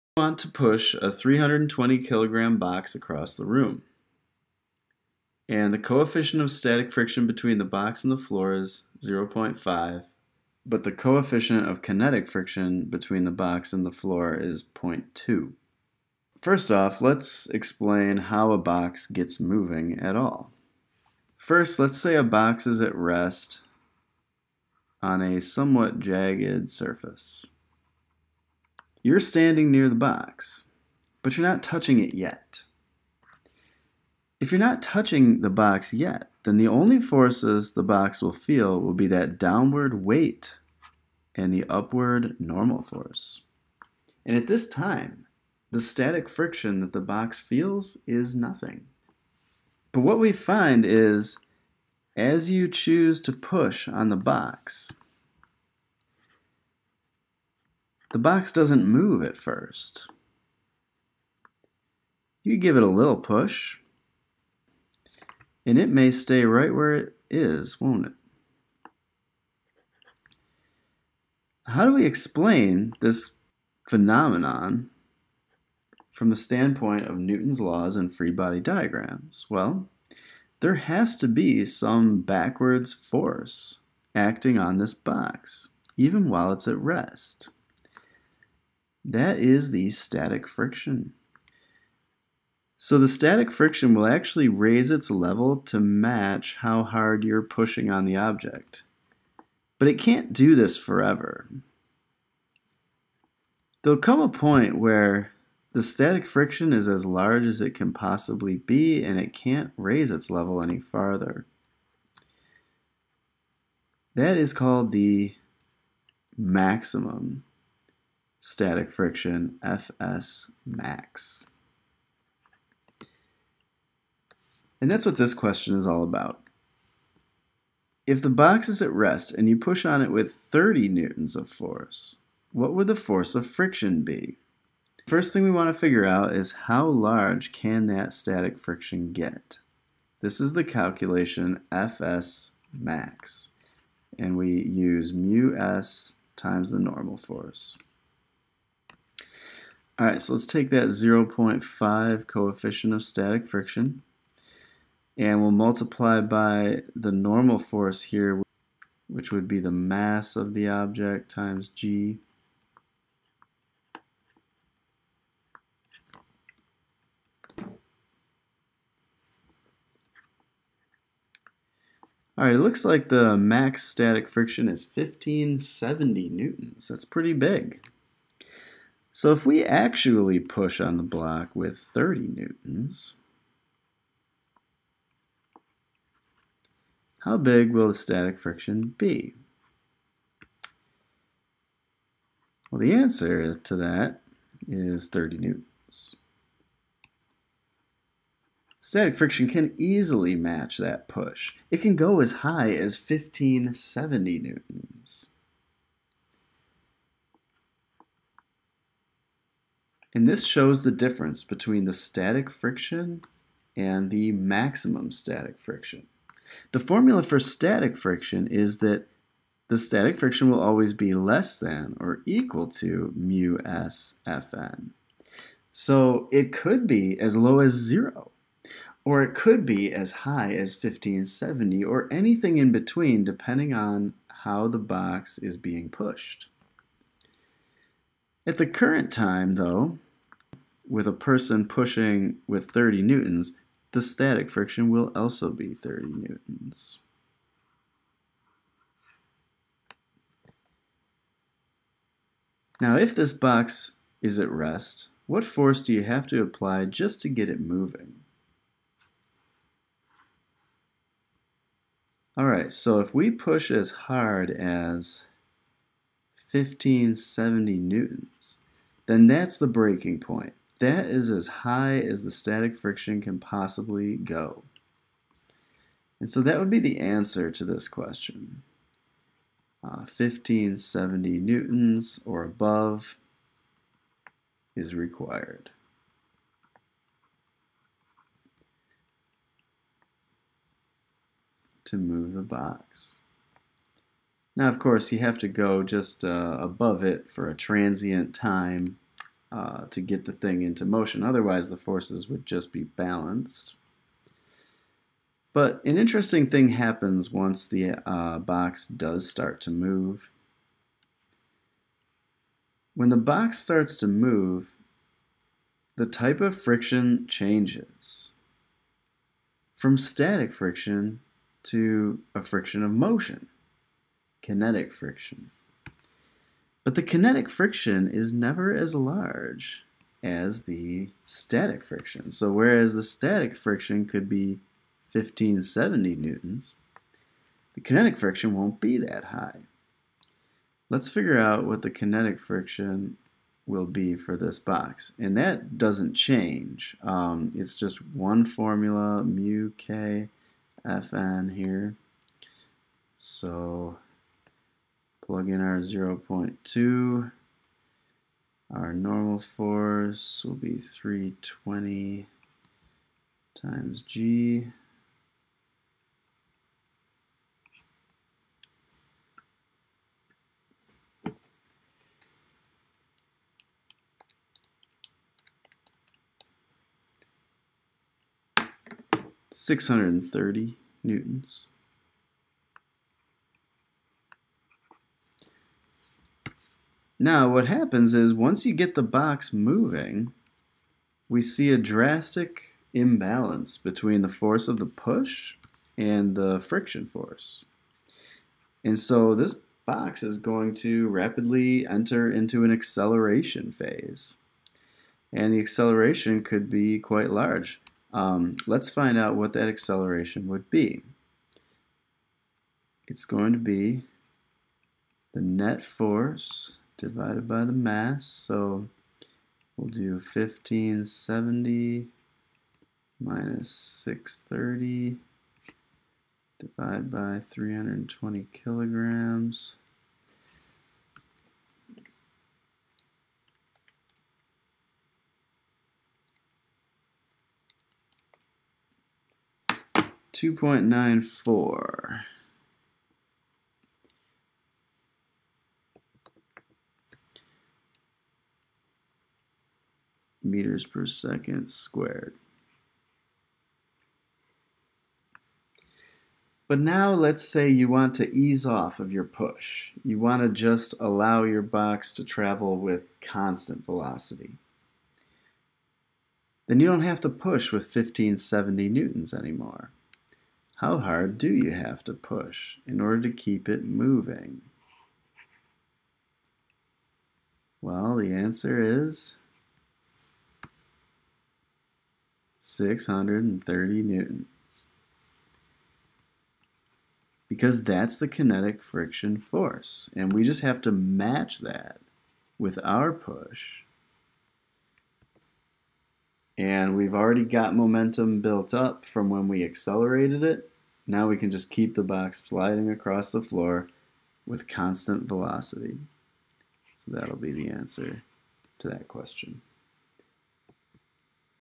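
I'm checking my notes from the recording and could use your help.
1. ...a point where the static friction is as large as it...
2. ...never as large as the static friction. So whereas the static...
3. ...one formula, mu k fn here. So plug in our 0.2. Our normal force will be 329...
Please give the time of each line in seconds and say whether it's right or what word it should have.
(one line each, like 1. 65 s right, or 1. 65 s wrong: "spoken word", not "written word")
1. 104 s right
2. 328 s right
3. 348 s wrong: "320", not "329".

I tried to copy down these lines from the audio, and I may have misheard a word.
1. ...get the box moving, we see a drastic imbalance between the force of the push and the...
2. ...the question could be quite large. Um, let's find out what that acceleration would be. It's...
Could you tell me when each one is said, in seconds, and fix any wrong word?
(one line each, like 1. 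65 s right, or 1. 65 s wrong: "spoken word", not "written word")
1. 388 s right
2. 405 s wrong: "acceleration", not "question".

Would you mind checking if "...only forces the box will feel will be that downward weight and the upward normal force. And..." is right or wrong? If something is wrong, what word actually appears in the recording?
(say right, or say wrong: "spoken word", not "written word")
right.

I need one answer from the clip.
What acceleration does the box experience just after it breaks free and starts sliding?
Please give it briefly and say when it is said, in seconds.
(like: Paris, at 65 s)
2.94 m/s², at 440 s.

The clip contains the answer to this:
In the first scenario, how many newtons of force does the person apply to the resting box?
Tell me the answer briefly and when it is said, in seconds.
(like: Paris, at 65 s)
30 newtons, at 130 s.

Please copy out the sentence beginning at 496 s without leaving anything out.
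And we've already got momentum built up from when we accelerated it.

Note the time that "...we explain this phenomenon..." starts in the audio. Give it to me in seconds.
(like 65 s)
71 s.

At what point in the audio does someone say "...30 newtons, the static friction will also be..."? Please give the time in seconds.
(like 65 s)
242 s.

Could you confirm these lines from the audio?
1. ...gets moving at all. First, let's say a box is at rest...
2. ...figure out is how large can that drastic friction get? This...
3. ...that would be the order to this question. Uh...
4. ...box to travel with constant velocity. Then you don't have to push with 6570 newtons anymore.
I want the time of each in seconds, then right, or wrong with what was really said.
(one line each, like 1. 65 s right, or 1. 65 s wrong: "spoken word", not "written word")
1. 19 s right
2. 135 s wrong: "static", not "drastic"
3. 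276 s wrong: "answer", not "order"
4. 461 s wrong: "1570", not "6570".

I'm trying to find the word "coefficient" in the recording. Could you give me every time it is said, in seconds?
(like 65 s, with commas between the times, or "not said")
5 s, 10 s, 152 s.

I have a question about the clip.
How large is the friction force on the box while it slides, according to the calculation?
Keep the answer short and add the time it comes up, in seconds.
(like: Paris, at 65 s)
630 newtons, at 379 s.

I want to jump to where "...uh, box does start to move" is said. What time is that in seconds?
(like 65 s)
308 s.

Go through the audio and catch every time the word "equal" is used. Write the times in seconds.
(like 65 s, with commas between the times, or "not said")
222 s.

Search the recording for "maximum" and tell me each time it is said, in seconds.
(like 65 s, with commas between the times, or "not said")
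116 s, 214 s.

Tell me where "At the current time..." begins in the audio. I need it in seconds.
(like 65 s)
238 s.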